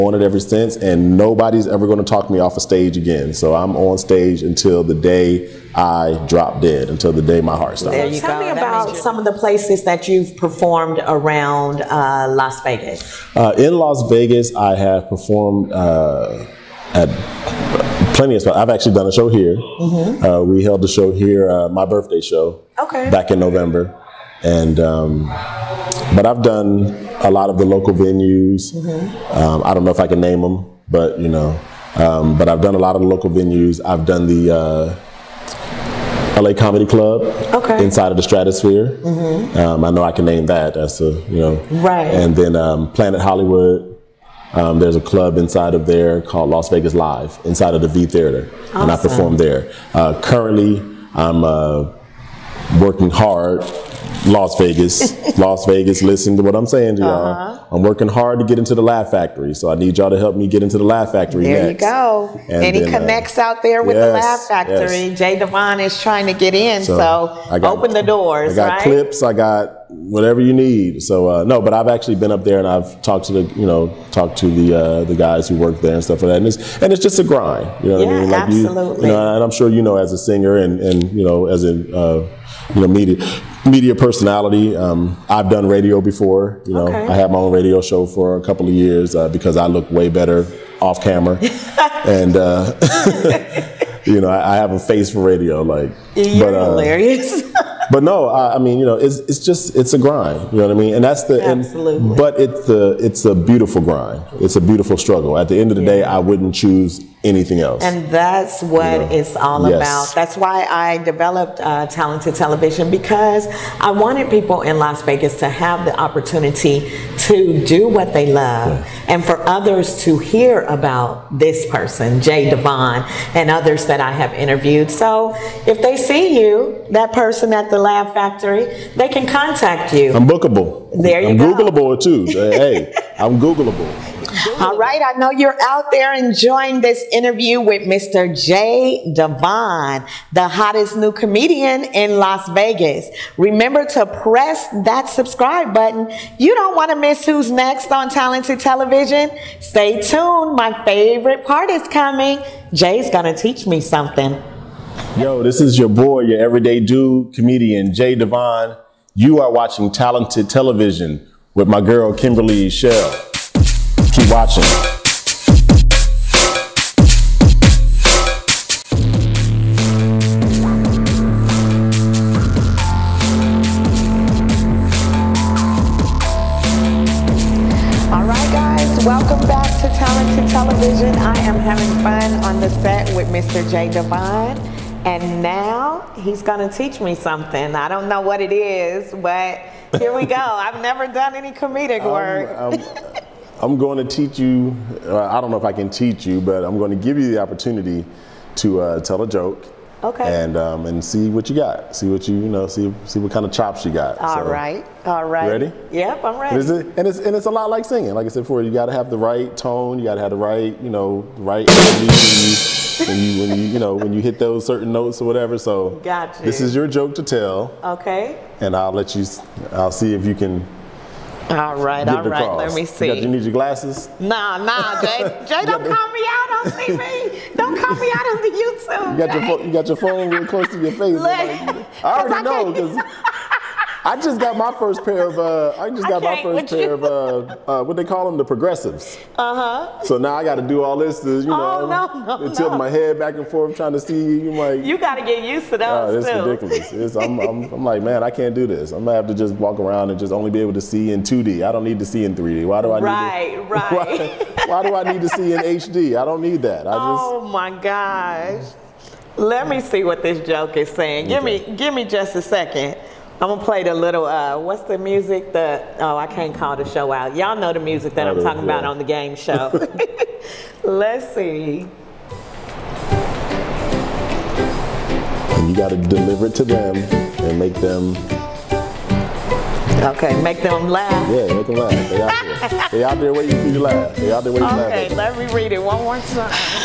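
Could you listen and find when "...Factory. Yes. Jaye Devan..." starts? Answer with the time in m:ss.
1:04.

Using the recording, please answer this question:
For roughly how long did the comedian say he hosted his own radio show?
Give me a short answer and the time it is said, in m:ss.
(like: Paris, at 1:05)
a couple of years, at 1:28.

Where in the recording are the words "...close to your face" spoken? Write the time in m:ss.
3:50.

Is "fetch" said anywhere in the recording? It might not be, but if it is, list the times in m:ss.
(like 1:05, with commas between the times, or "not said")
not said.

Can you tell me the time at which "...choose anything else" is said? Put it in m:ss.
1:46.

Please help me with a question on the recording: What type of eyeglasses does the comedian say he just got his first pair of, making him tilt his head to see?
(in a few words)
progressives.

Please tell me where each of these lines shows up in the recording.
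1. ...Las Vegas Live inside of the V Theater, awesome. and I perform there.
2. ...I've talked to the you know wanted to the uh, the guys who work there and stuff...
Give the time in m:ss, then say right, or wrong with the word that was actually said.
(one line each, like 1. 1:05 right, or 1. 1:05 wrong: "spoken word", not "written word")
1. 0:46 right
2. 1:12 wrong: "talked", not "wanted".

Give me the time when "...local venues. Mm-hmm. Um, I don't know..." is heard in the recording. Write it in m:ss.
0:27.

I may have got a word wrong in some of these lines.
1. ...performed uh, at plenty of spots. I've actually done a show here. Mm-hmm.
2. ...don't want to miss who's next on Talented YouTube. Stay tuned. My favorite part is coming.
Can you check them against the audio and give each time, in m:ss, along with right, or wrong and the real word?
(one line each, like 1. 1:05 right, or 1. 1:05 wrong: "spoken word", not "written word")
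1. 0:15 right
2. 2:26 wrong: "Television", not "YouTube".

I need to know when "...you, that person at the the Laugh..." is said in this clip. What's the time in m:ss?
2:06.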